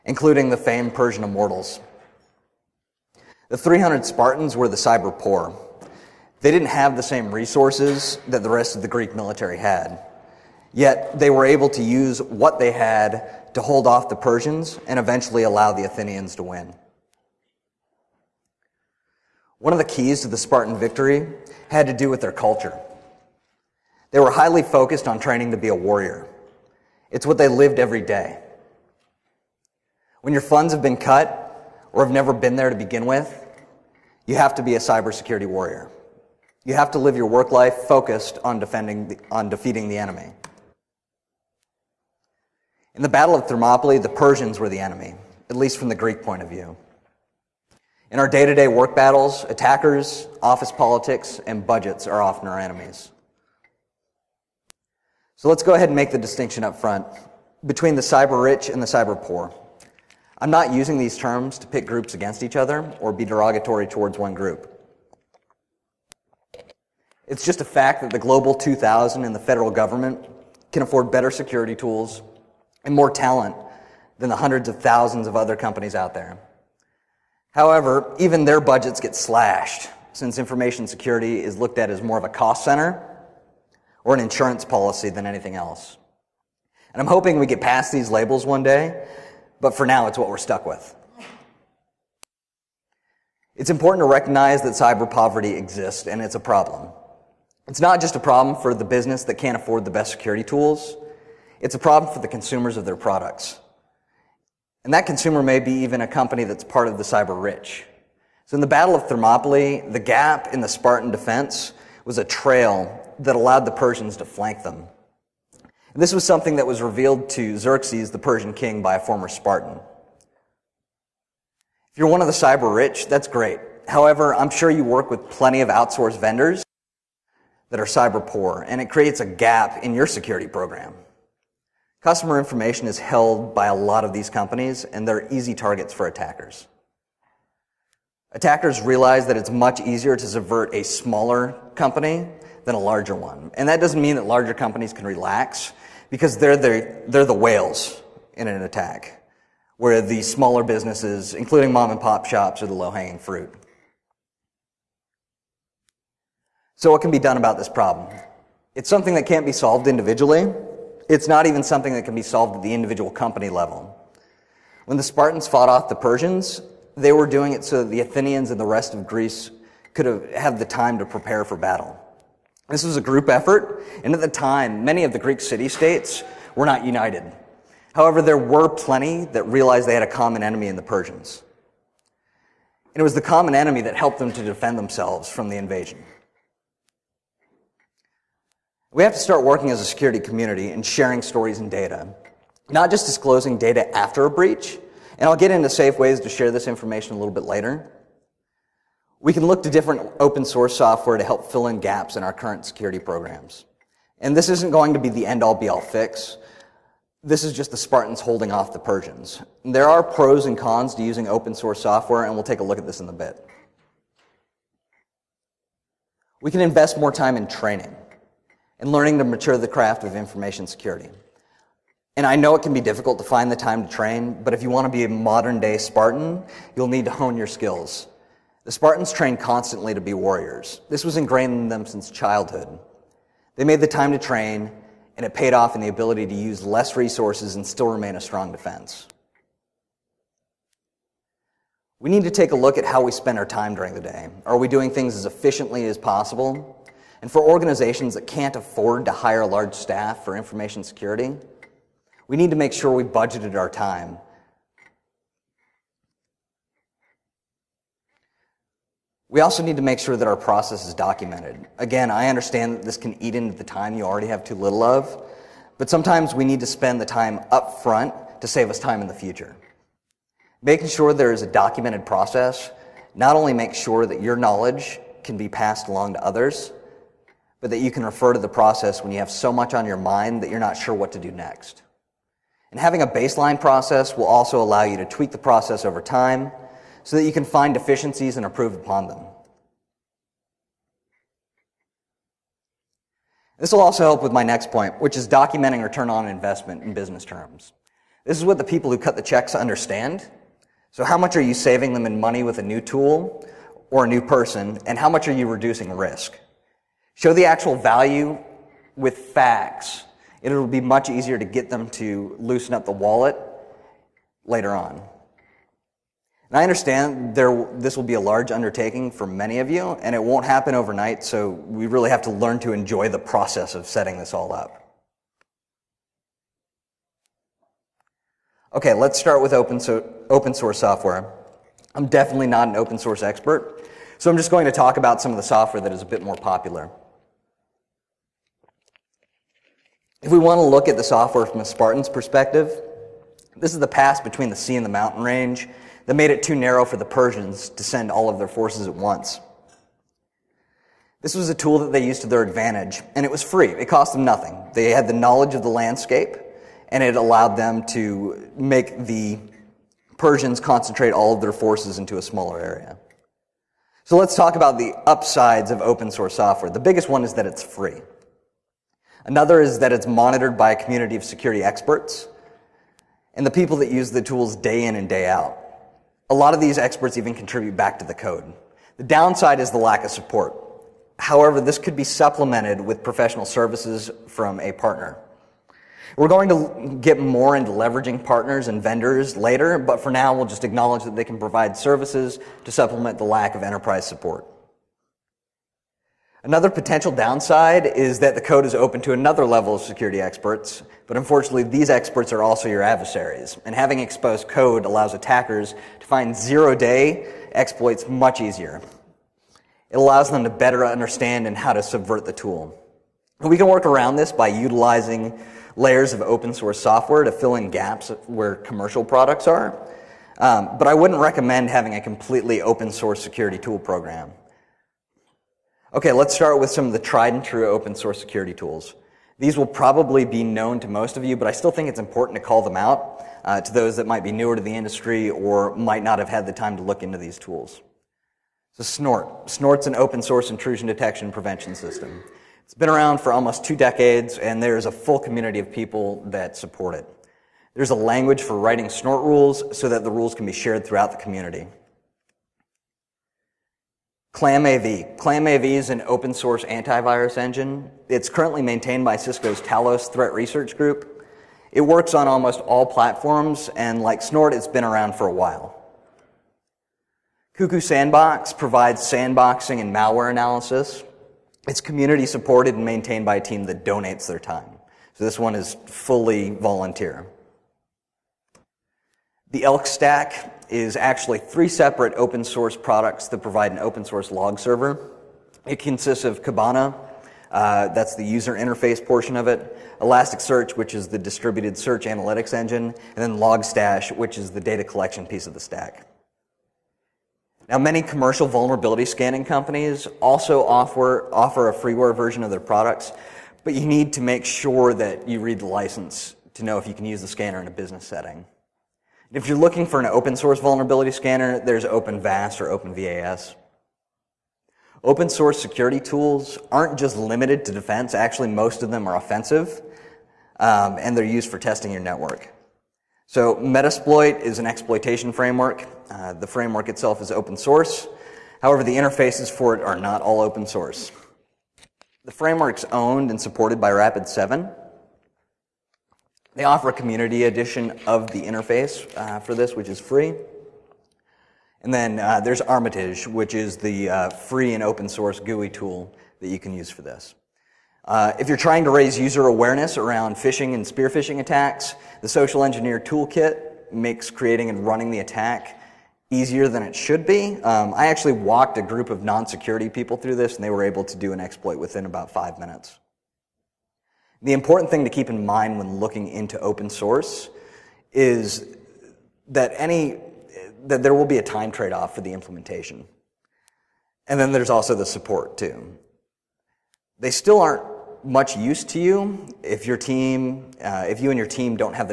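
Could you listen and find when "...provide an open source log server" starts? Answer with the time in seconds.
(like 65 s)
483 s.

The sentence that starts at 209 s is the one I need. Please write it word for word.
There are pros and cons to using open source software, and we'll take a look at this in a bit.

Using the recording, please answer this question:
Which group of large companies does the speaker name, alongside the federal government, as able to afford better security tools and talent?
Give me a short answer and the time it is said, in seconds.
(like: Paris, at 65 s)
Global 2000, at 68 s.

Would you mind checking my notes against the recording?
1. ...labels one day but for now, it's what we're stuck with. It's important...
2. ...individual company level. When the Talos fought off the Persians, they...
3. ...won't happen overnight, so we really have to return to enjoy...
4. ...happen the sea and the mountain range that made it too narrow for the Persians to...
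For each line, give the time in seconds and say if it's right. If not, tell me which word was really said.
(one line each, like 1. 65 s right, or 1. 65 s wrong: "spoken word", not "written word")
1. 88 s right
2. 162 s wrong: "Spartans", not "Talos"
3. 320 s wrong: "learn", not "return"
4. 344 s wrong: "between", not "happen".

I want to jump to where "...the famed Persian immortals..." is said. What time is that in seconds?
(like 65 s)
0 s.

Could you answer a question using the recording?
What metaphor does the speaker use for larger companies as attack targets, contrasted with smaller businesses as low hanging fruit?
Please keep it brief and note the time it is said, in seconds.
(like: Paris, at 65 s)
whales, at 147 s.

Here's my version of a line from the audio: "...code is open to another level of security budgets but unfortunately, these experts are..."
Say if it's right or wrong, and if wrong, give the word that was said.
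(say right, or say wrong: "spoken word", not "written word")
wrong: "experts", not "budgets".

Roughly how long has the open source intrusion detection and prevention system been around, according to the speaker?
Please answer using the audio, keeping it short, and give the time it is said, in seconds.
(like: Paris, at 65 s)
almost two decades, at 443 s.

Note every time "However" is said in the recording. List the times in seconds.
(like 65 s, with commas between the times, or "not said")
77 s, 123 s, 177 s, 381 s, 528 s.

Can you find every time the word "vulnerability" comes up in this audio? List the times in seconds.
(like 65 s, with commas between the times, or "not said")
498 s, 510 s.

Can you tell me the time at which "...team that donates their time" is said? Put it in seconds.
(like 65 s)
473 s.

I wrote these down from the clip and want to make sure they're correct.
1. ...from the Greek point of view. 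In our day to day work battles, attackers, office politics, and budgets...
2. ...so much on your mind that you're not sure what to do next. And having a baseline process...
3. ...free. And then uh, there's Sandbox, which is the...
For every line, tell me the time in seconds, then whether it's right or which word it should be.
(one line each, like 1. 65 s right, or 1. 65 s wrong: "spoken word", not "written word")
1. 45 s right
2. 279 s right
3. 540 s wrong: "Armitage", not "Sandbox".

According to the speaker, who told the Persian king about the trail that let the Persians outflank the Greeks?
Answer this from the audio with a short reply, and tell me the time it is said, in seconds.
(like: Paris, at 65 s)
a former Spartan, at 118 s.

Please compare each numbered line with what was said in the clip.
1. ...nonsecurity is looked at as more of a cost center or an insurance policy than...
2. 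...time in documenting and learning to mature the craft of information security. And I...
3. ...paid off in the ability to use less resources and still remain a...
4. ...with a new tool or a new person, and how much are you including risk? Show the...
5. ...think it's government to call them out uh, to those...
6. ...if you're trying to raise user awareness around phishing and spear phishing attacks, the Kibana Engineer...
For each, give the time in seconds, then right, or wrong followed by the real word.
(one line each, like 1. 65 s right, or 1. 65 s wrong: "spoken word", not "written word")
1. 80 s wrong: "security", not "nonsecurity"
2. 217 s wrong: "training", not "documenting"
3. 235 s right
4. 302 s wrong: "reducing", not "including"
5. 431 s wrong: "important", not "government"
6. 548 s wrong: "Social", not "Kibana".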